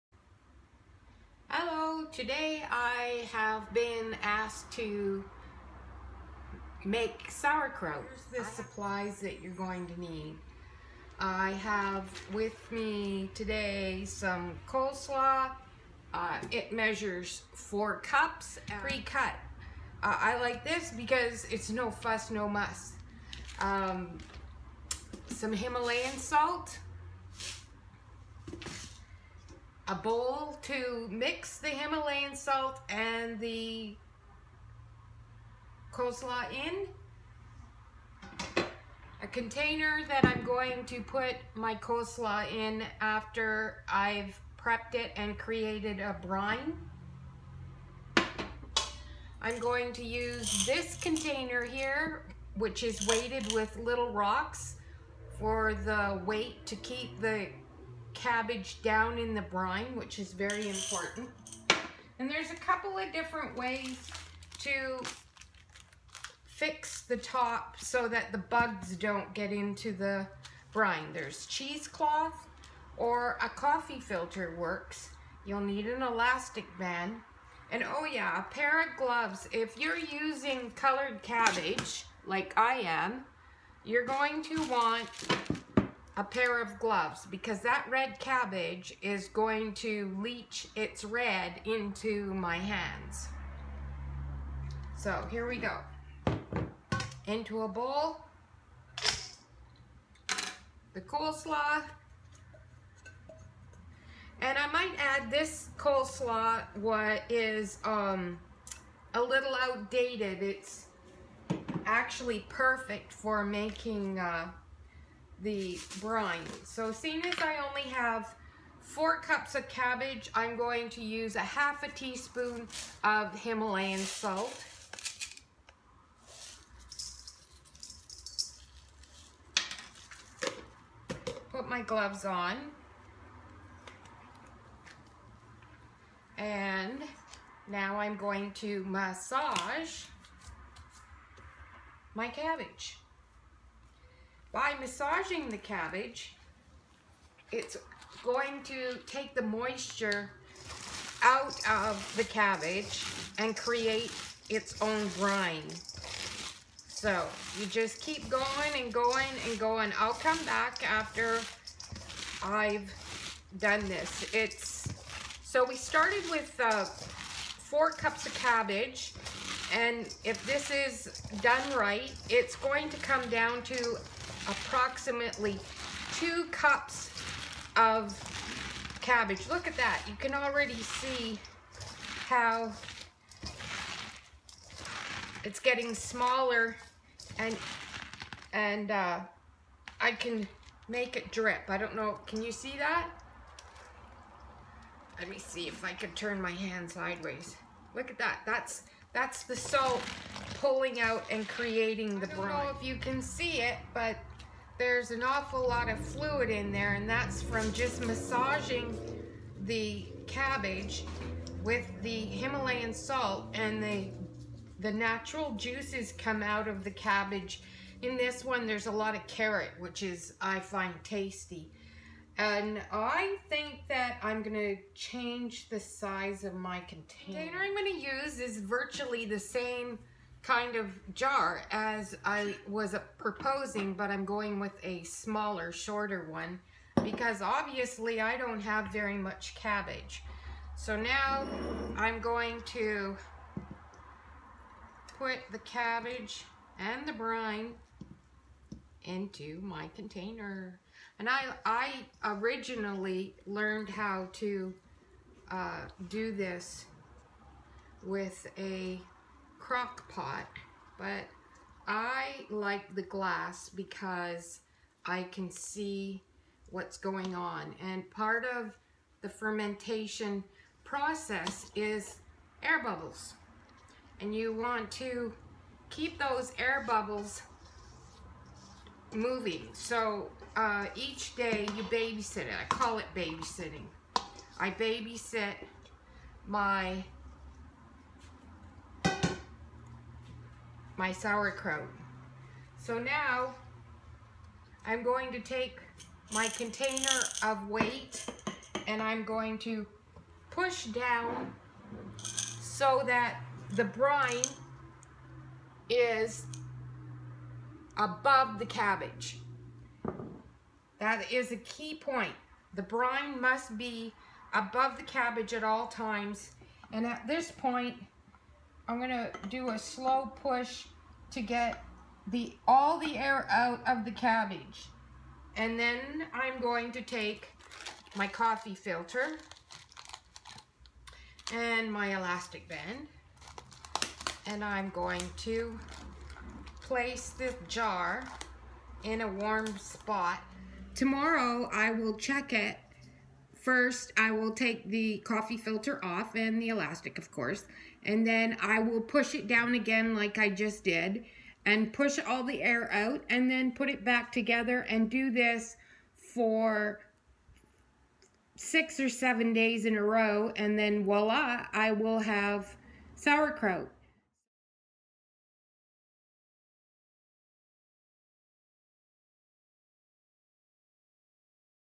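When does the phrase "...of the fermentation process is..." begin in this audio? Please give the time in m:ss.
4:28.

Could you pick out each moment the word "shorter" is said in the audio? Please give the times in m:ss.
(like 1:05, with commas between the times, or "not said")
3:55.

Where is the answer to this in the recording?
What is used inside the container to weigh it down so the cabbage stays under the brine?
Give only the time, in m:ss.
0:53.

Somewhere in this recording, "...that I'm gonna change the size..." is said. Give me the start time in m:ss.
3:43.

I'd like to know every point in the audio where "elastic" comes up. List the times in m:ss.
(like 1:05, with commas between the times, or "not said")
1:16, 5:32, 5:46.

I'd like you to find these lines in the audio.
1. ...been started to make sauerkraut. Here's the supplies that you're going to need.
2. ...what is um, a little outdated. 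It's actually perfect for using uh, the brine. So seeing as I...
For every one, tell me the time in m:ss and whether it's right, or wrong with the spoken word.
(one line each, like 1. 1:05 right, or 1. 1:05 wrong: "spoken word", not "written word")
1. 0:03 wrong: "asked", not "started"
2. 1:46 wrong: "making", not "using".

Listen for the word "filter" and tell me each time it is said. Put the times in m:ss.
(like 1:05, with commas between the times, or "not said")
1:13, 5:28, 5:45.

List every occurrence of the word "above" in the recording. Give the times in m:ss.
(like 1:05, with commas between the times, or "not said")
5:07, 5:14.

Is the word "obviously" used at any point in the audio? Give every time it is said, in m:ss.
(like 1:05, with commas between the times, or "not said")
3:57.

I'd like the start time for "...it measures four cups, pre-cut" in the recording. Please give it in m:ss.
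0:16.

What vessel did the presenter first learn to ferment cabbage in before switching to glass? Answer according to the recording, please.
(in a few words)
crock pot.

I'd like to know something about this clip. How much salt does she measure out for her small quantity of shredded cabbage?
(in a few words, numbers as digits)
1/2 teaspoon.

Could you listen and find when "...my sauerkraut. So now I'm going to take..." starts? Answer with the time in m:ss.
4:50.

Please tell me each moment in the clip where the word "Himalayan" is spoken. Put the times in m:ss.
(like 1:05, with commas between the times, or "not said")
0:25, 0:31, 2:03, 3:32.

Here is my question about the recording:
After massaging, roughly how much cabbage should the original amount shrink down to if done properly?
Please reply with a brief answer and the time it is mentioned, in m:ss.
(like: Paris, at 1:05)
2 cups, at 2:56.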